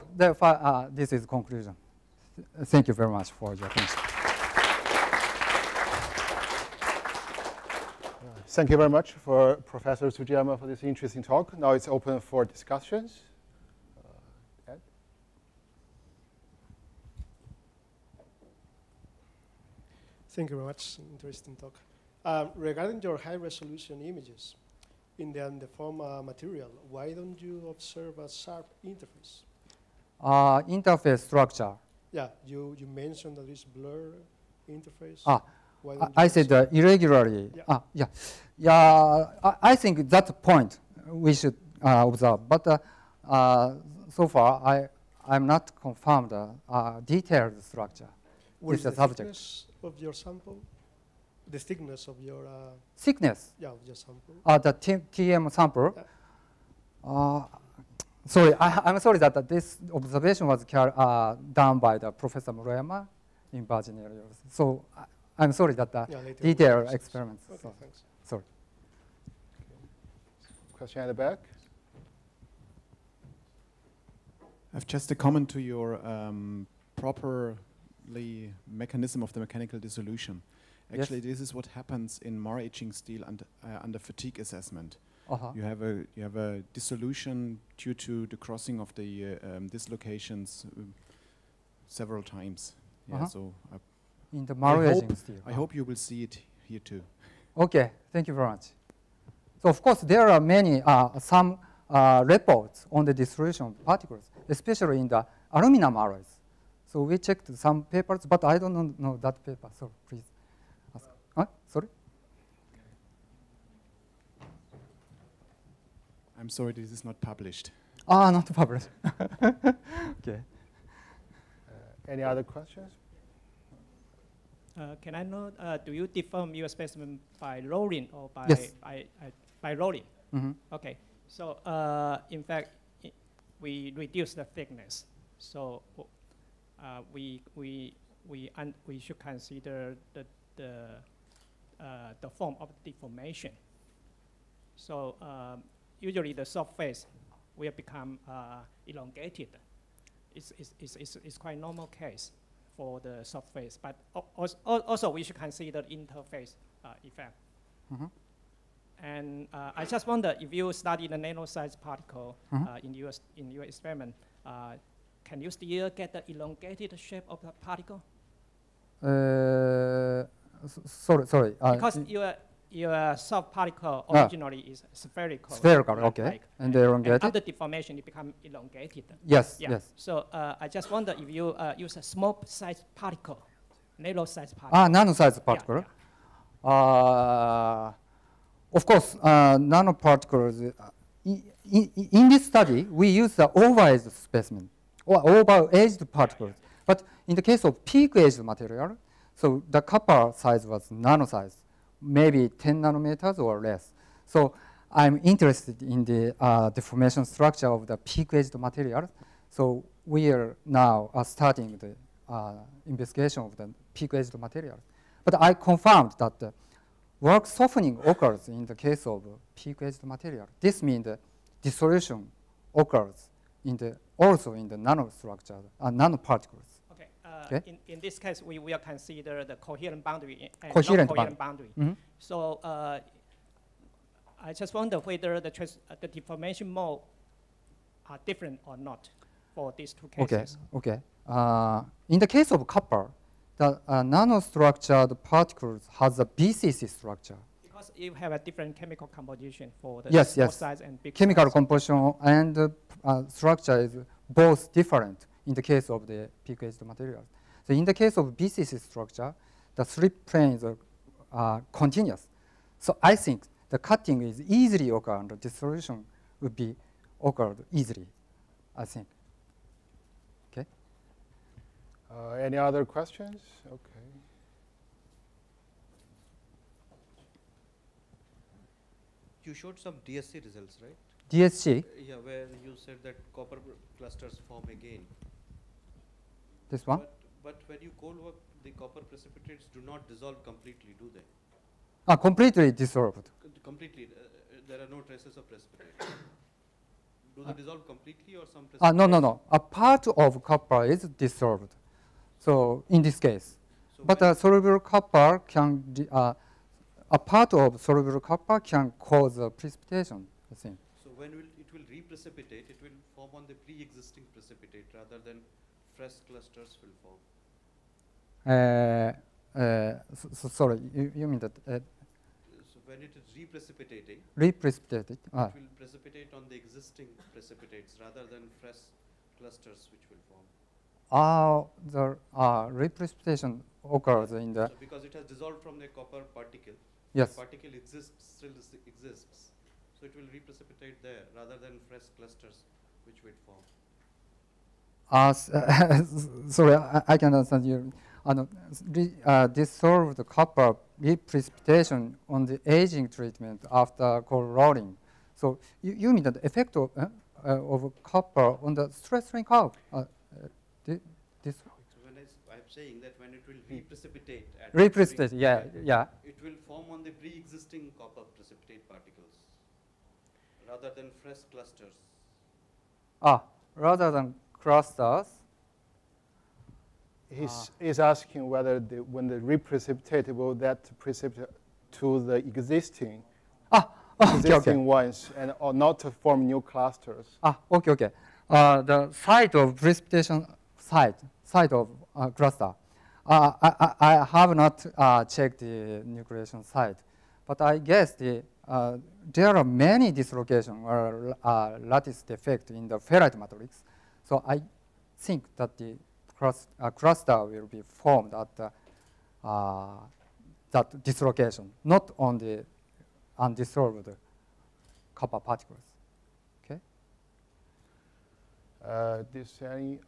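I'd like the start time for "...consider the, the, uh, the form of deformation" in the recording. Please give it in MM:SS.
02:19.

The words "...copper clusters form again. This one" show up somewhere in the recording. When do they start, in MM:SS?
04:43.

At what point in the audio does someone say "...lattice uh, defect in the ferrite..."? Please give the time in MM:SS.
06:41.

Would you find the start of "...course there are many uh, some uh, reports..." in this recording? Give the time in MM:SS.
01:39.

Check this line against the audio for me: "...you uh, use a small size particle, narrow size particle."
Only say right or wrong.
right.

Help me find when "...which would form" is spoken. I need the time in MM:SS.
05:43.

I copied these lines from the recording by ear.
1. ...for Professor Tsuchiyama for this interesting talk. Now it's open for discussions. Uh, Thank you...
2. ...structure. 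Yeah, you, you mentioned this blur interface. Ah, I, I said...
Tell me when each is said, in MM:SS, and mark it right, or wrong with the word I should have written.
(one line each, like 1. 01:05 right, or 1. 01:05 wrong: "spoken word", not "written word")
1. 00:09 right
2. 00:31 right.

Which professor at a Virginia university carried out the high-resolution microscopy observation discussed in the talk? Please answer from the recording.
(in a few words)
Professor Murayama.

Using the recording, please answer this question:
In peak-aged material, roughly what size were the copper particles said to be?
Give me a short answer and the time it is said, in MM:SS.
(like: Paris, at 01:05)
10 nanometers or less, at 03:22.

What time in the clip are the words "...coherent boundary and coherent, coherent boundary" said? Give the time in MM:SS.
03:49.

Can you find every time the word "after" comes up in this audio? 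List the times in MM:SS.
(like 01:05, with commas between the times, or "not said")
02:57, 05:53.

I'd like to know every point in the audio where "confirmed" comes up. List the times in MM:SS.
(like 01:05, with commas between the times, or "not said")
00:45, 03:35.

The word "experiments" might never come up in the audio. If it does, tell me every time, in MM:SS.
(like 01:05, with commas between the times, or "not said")
01:06, 02:43.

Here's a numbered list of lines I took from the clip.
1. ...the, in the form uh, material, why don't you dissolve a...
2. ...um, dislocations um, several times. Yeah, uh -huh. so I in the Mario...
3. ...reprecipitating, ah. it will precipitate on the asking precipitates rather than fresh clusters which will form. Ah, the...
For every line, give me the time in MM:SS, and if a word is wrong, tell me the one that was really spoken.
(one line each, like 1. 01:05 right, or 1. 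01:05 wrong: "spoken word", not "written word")
1. 00:25 wrong: "observe", not "dissolve"
2. 01:29 right
3. 05:24 wrong: "existing", not "asking".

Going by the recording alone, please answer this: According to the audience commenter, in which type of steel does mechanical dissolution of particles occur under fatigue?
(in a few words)
Maraging steel.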